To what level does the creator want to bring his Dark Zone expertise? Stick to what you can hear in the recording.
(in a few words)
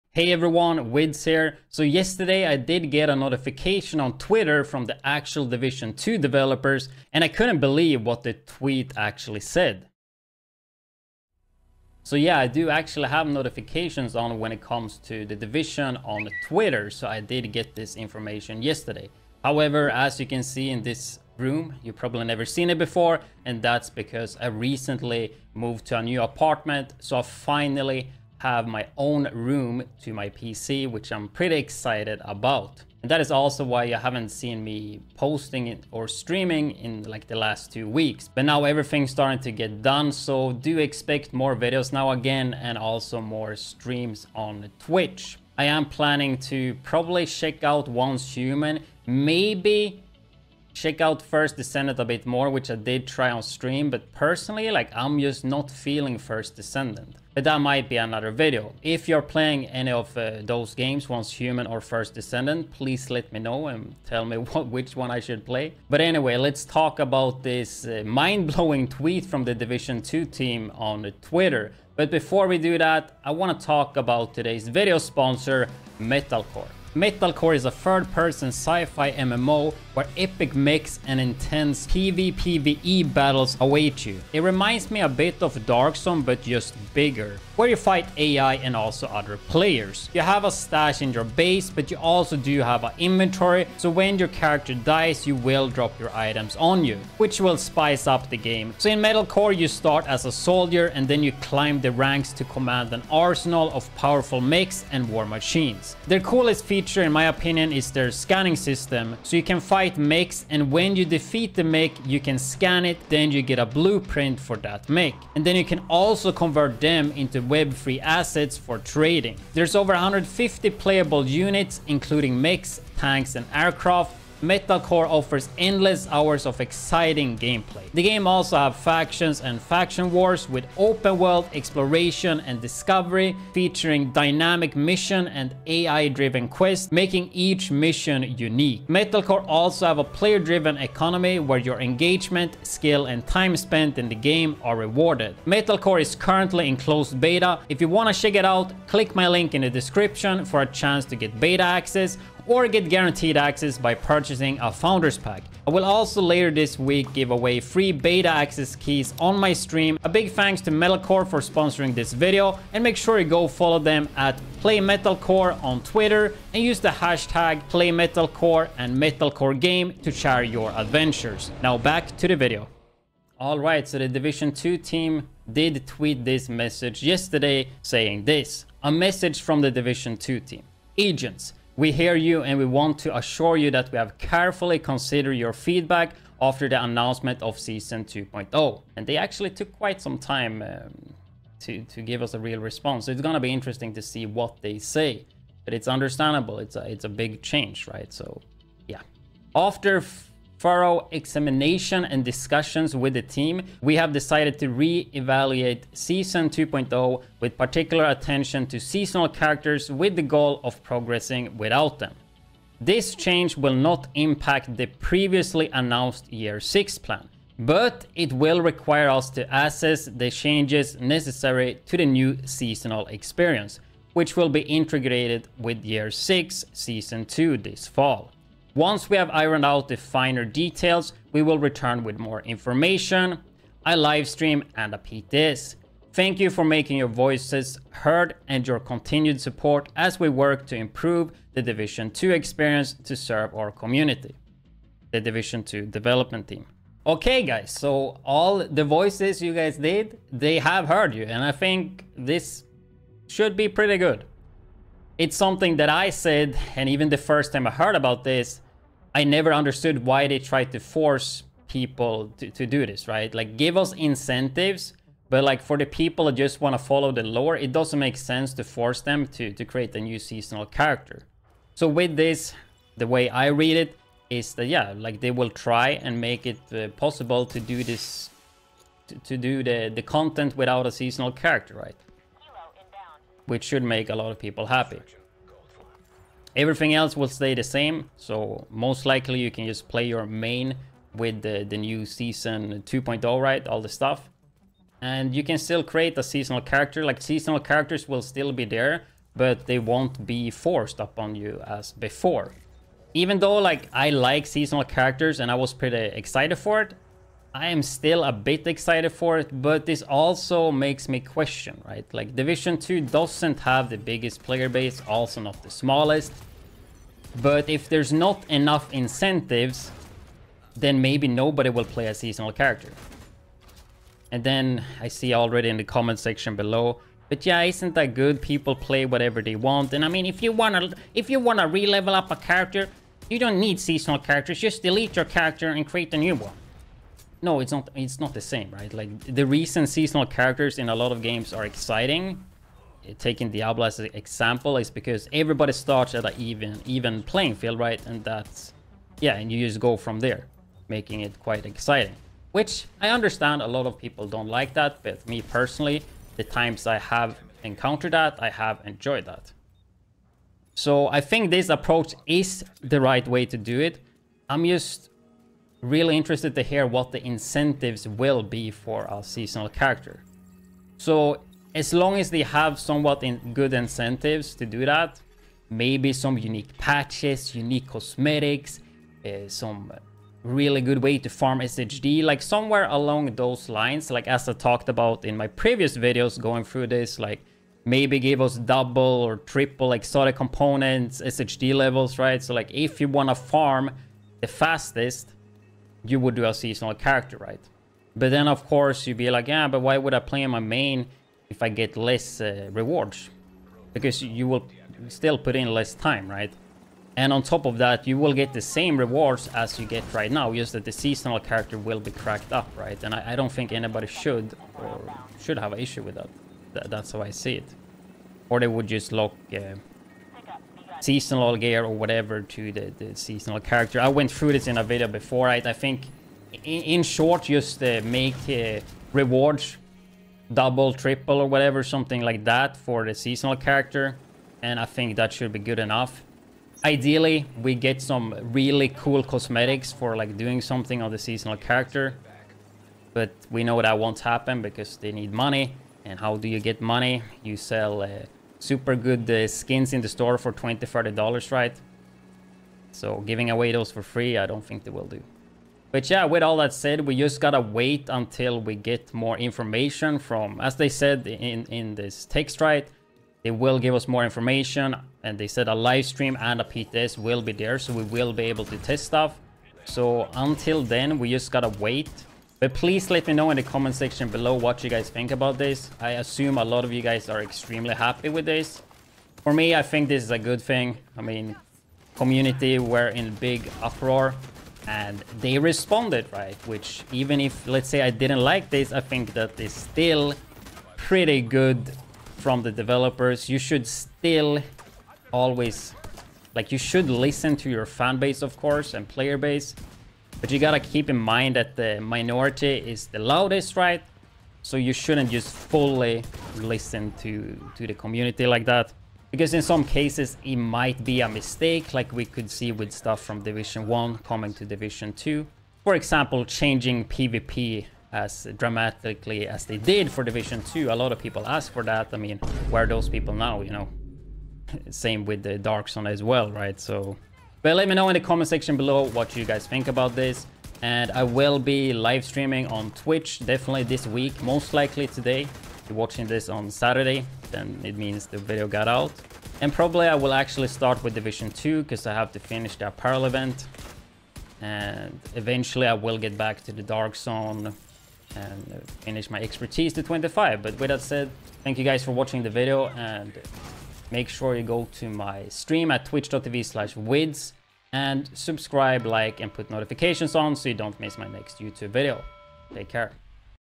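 25.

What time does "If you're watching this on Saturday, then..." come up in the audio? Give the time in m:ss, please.
8:55.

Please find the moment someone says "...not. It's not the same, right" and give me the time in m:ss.
5:37.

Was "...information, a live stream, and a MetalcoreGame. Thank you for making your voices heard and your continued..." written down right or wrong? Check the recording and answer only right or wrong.
wrong.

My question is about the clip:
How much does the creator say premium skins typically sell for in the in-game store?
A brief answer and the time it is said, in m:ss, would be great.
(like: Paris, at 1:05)
20-30 dollars, at 7:30.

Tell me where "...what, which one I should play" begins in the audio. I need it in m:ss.
1:04.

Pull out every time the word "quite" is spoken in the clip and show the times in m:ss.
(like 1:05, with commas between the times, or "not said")
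3:09, 5:51.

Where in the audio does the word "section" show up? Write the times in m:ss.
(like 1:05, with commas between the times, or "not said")
5:26, 7:53, 8:48.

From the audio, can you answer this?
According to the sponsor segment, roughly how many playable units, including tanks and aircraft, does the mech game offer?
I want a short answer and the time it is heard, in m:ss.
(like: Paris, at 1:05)
150, at 1:59.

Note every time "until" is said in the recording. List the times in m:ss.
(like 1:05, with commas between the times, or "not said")
7:38, 7:50.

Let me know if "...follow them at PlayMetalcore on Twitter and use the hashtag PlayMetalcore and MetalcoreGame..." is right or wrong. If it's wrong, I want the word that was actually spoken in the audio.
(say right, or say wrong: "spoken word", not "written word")
right.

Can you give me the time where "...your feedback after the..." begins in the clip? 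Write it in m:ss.
3:05.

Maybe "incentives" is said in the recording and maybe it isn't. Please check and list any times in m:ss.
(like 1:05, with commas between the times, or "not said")
4:23, 5:18, 6:07, 6:13.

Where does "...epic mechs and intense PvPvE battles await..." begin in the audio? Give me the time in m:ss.
1:20.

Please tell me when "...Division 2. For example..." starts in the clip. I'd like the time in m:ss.
8:34.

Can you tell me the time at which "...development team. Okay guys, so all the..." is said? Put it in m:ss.
4:05.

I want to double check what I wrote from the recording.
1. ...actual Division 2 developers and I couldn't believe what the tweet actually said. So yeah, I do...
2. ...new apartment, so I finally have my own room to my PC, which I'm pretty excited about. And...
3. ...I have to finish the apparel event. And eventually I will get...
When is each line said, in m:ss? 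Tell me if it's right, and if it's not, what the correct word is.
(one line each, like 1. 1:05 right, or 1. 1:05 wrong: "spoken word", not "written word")
1. 0:05 right
2. 0:26 right
3. 9:02 right.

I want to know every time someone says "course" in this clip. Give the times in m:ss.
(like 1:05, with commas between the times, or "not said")
6:38, 8:18.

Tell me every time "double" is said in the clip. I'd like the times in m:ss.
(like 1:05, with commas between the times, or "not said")
6:28, 7:10.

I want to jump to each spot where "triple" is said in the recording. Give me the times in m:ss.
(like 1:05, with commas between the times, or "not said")
6:29, 7:10.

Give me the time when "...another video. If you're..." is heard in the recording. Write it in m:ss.
0:57.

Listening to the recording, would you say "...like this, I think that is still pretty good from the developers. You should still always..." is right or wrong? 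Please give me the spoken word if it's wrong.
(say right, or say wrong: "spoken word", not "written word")
right.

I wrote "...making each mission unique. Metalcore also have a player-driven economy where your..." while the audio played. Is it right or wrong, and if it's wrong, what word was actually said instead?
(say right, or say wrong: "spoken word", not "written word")
right.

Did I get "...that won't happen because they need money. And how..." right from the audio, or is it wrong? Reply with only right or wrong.
right.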